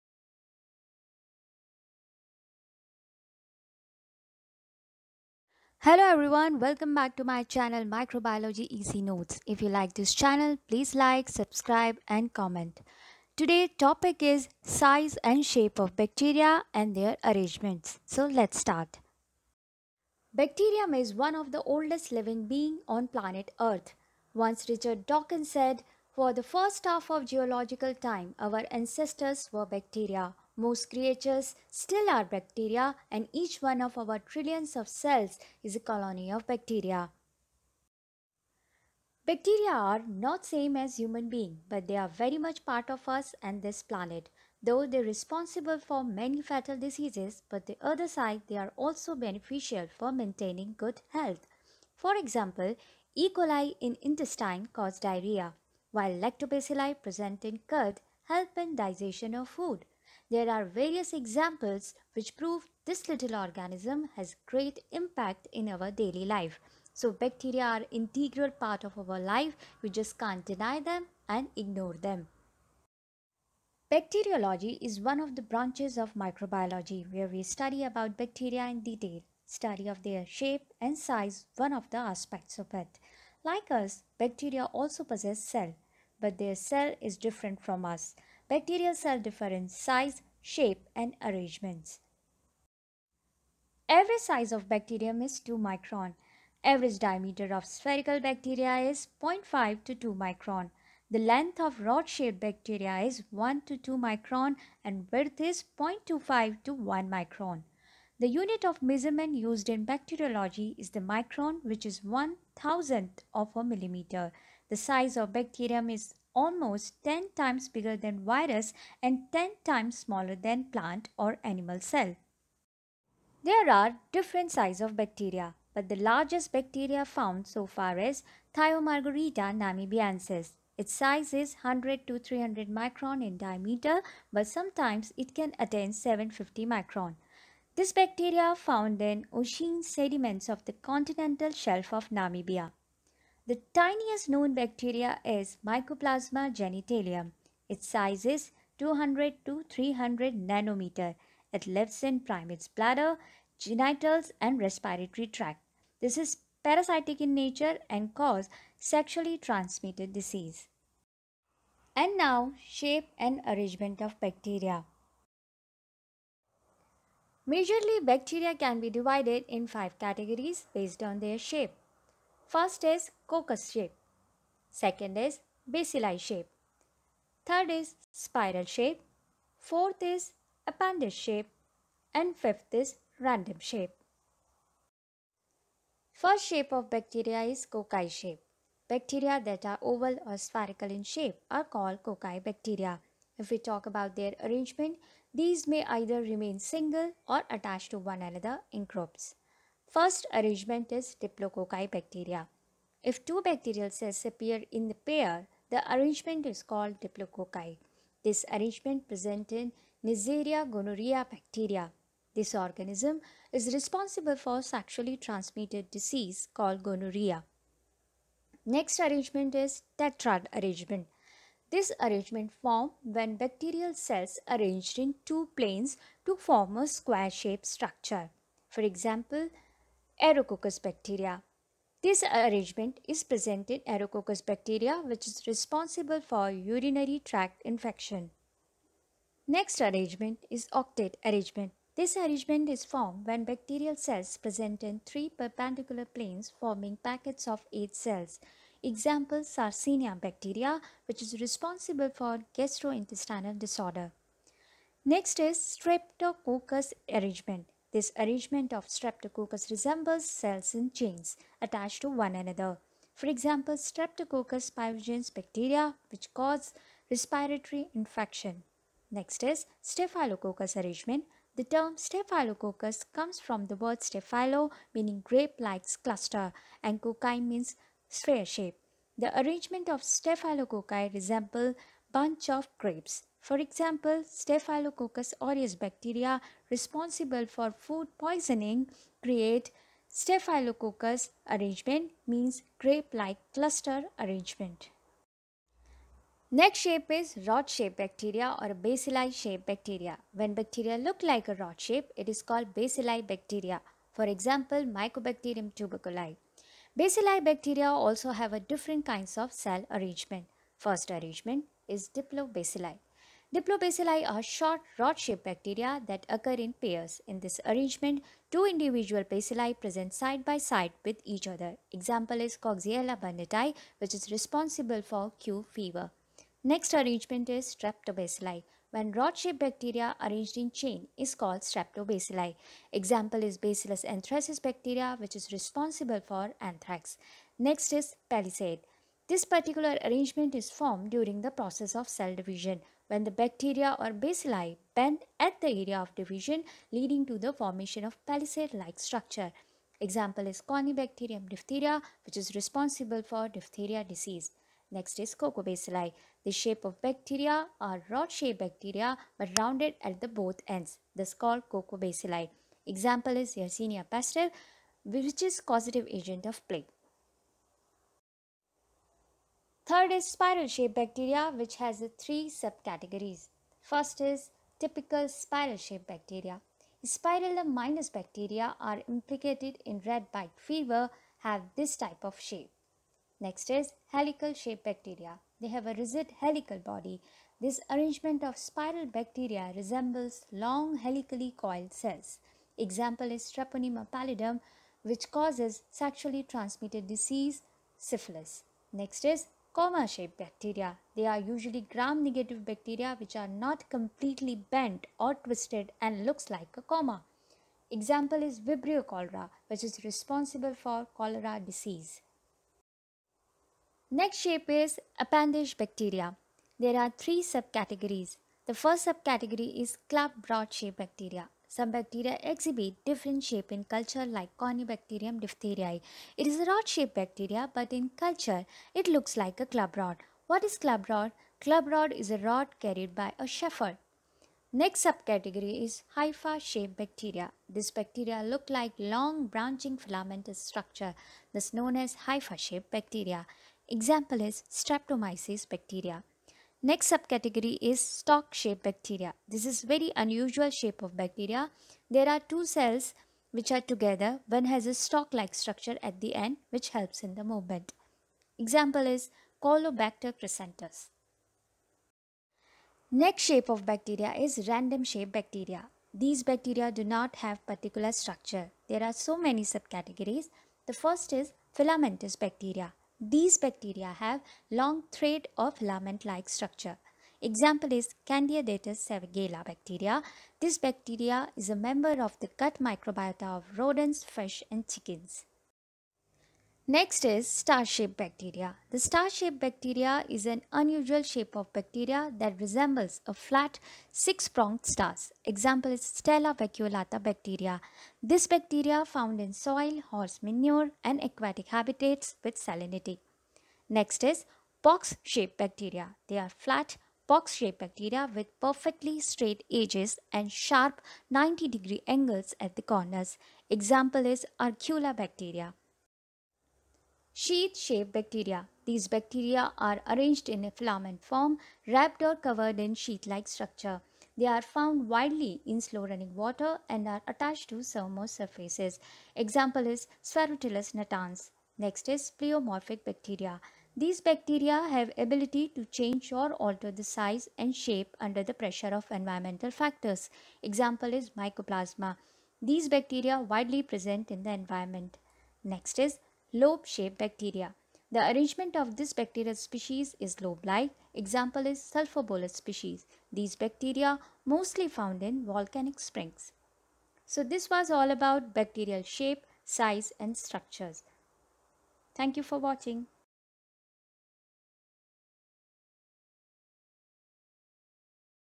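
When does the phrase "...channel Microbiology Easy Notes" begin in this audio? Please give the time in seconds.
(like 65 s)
7 s.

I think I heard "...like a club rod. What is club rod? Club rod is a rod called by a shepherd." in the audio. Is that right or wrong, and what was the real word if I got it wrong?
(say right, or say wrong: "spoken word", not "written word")
wrong: "carried", not "called".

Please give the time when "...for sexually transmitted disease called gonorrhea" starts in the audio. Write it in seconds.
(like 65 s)
214 s.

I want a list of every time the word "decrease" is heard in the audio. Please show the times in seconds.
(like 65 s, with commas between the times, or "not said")
not said.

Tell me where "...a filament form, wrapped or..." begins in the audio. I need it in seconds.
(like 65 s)
520 s.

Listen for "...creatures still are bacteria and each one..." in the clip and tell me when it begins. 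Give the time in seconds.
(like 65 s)
30 s.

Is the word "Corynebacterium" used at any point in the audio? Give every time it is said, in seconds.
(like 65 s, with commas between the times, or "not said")
350 s, 424 s.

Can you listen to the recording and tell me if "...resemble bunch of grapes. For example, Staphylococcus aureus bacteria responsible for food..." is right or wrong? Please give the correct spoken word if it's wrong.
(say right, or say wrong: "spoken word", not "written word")
right.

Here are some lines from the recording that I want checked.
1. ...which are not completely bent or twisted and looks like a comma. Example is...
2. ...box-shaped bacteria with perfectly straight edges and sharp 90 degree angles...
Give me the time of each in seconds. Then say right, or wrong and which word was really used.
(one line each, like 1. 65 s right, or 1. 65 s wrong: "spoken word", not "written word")
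1. 403 s right
2. 507 s right.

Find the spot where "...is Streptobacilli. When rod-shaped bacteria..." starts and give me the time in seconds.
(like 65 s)
327 s.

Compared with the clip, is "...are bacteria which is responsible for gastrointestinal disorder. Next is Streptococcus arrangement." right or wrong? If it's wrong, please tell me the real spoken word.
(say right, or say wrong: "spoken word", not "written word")
right.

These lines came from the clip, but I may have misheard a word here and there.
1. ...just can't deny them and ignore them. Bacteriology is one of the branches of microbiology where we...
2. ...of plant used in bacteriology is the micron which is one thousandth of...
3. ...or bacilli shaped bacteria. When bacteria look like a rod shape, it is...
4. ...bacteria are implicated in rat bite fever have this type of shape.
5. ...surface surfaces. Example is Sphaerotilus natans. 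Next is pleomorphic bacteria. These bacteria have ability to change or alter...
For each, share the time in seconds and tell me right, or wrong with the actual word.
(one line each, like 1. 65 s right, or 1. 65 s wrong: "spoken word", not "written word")
1. 69 s right
2. 108 s wrong: "measurement", not "plant"
3. 298 s right
4. 378 s right
5. 527 s right.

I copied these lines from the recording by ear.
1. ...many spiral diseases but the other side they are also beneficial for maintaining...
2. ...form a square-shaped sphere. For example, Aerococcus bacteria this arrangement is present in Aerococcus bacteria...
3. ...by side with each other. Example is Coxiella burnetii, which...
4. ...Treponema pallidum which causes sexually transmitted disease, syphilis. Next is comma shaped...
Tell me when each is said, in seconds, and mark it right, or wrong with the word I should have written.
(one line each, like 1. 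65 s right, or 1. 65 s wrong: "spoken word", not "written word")
1. 46 s wrong: "fatal", not "spiral"
2. 226 s wrong: "structure", not "sphere"
3. 320 s right
4. 393 s right.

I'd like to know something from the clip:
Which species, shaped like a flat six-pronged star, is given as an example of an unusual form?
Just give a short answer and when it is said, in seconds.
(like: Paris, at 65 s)
Stella vacuolata, at 496 s.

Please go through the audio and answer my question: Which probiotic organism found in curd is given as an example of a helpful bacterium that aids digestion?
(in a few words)
Lactobacilli.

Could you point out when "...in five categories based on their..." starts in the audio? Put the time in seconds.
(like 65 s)
169 s.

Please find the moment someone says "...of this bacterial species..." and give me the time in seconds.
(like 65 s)
548 s.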